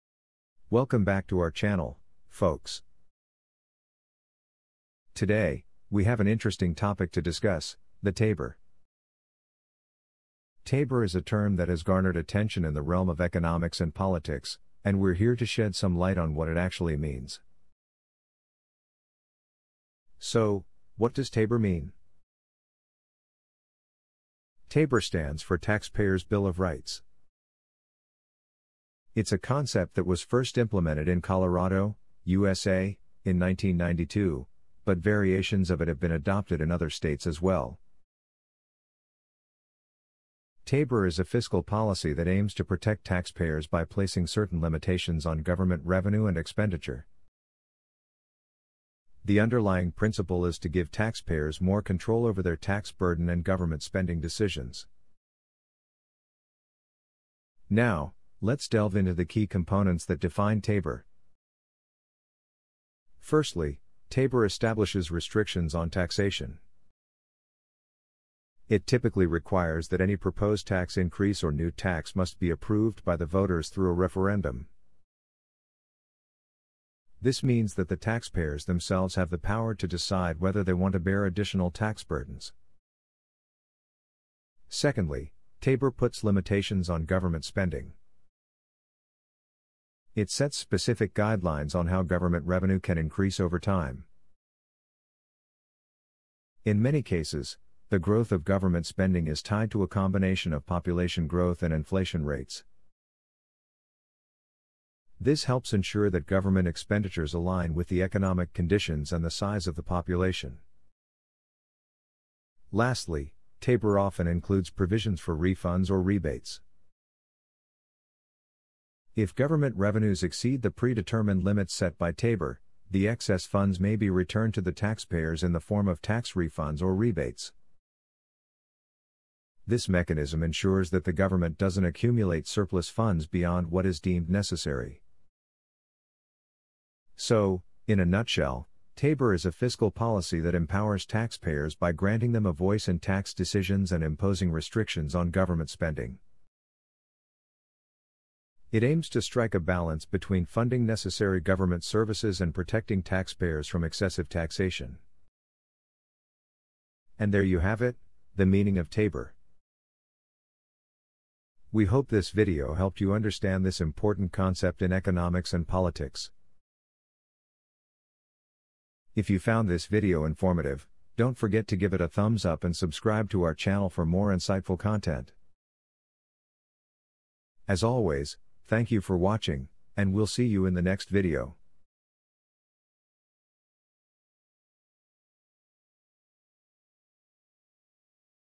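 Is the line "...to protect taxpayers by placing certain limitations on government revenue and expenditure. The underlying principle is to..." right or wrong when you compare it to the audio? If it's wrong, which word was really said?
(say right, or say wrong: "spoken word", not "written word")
right.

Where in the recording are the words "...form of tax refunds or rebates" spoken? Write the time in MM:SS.
02:05.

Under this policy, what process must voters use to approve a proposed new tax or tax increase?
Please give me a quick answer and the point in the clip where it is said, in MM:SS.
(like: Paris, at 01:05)
A referendum, at 01:13.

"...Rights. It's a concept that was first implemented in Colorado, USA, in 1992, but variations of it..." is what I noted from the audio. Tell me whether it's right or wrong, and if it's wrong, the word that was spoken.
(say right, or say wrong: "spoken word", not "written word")
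right.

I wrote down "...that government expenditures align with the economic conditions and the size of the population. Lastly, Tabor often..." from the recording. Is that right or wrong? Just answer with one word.
right.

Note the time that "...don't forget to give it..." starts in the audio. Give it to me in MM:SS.
02:51.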